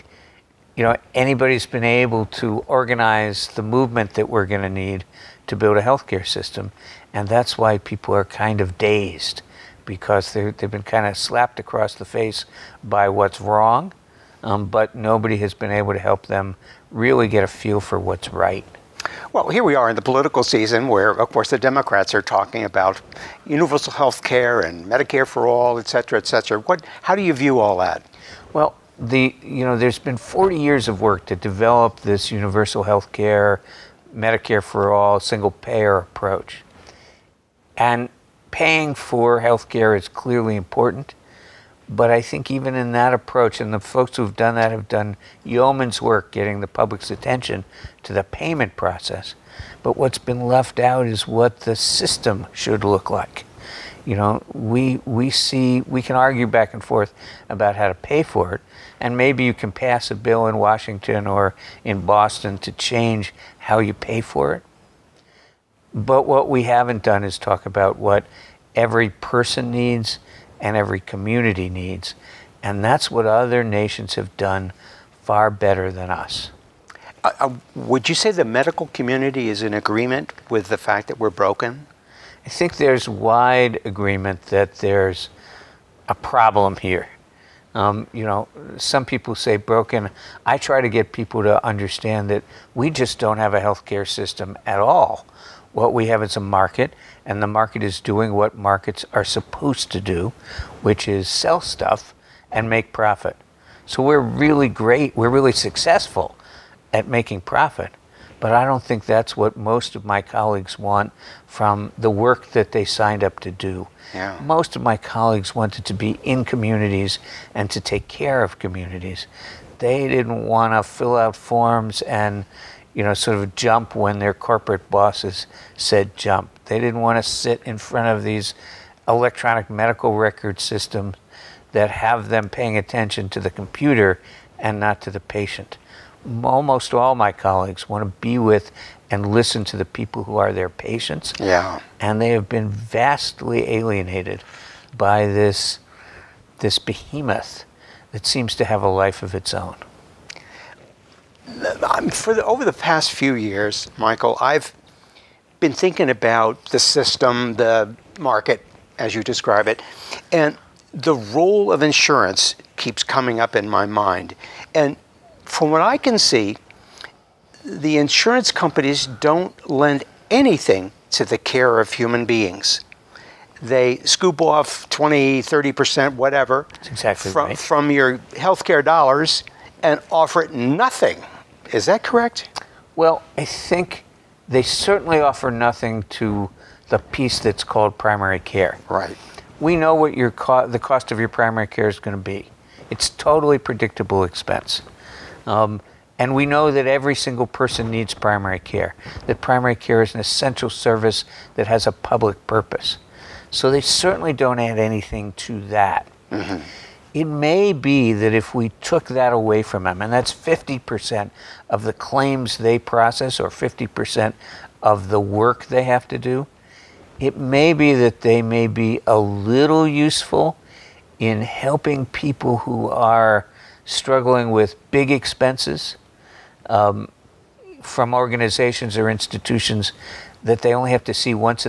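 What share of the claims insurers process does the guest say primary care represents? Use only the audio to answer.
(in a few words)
50%.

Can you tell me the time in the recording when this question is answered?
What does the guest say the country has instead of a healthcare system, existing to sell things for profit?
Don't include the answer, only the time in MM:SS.
01:36.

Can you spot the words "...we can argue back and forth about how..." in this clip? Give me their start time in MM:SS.
00:55.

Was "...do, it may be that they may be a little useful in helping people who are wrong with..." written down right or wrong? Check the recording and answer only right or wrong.
wrong.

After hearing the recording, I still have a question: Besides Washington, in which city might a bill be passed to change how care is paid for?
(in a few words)
Boston.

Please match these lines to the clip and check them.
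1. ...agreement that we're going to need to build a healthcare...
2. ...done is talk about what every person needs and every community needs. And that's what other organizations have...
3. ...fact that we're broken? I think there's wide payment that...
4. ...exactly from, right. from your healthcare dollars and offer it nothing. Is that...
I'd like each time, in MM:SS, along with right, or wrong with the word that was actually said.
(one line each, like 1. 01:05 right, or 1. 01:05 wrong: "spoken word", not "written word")
1. 00:03 wrong: "movement", not "agreement"
2. 01:07 wrong: "nations", not "organizations"
3. 01:20 wrong: "agreement", not "payment"
4. 02:56 right.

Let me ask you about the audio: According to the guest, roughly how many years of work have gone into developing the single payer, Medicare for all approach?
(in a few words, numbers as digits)
40 years.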